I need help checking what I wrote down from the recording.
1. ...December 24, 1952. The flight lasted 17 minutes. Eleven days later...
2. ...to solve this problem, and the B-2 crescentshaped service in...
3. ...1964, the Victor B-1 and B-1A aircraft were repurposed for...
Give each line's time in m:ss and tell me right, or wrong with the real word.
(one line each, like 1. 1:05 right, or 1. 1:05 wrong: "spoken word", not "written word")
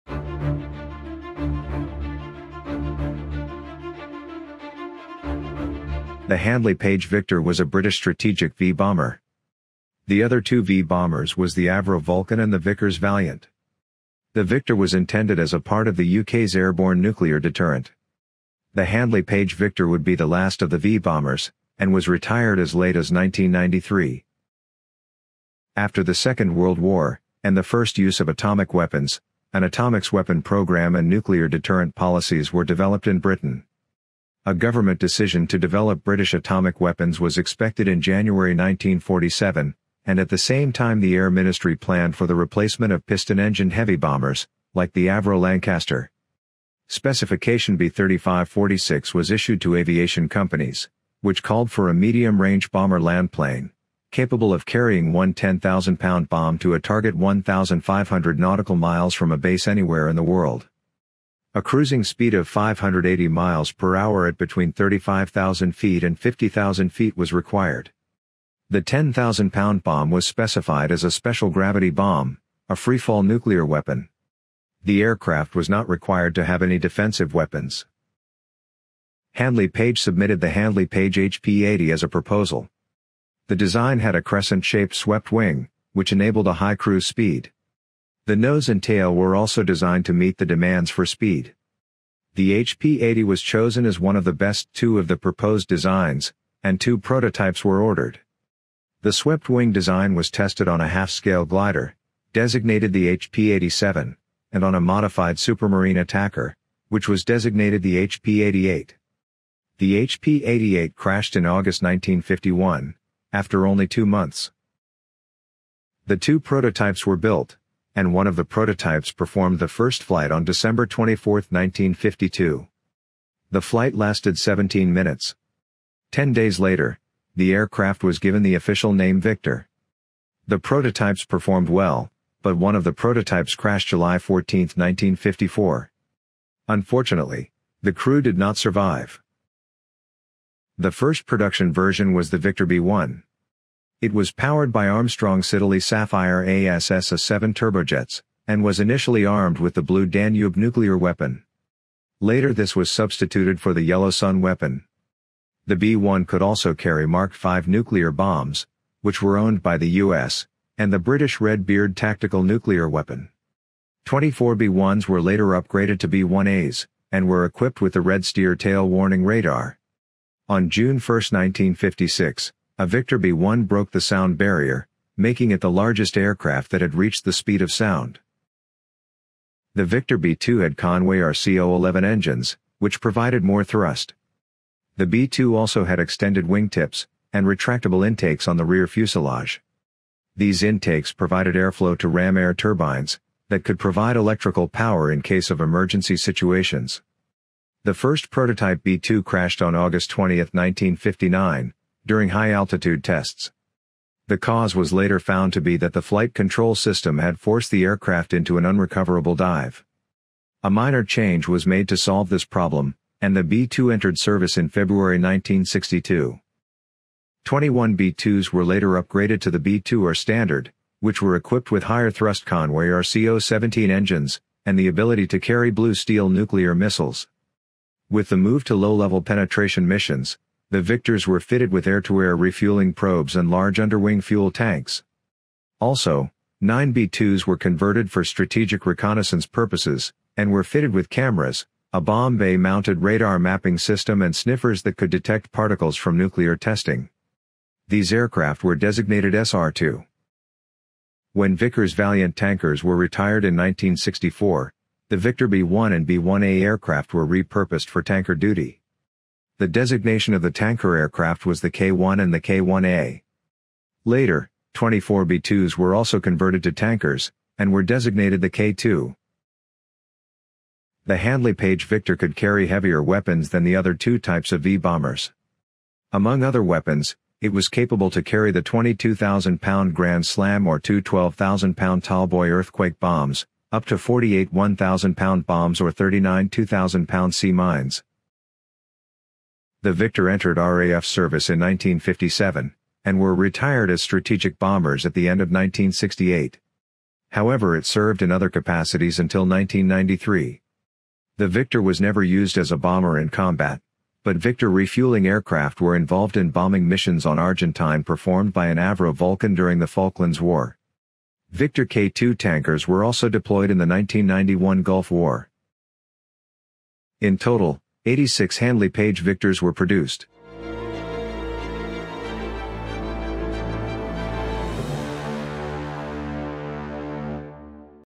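1. 2:00 wrong: "Ten", not "Eleven"
2. 3:31 wrong: "entered", not "crescentshaped"
3. 4:13 right.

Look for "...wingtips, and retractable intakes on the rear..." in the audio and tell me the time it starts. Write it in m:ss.
3:06.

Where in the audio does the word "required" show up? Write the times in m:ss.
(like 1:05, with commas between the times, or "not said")
1:07, 1:15.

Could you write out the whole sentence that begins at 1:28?
The nose and tail were also designed to meet the demands for speed.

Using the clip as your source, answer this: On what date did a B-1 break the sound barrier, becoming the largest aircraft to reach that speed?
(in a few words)
June 1, 1956.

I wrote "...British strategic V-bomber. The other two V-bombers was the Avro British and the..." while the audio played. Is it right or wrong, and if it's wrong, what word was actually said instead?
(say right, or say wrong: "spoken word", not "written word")
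wrong: "Vulcan", not "British".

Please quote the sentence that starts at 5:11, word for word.
Victor K-2 tankers were also deployed in the 1991 Gulf War.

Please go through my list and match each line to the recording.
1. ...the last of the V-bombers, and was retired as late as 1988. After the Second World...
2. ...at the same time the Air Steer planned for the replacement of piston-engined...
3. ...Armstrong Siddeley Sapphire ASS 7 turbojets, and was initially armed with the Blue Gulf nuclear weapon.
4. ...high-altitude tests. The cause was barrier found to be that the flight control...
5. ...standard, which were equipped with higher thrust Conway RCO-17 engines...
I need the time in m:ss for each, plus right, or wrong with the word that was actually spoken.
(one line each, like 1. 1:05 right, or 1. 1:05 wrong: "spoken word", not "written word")
1. 0:20 wrong: "1993", not "1988"
2. 0:40 wrong: "Ministry", not "Steer"
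3. 2:24 wrong: "Danube", not "Gulf"
4. 3:22 wrong: "later", not "barrier"
5. 3:40 right.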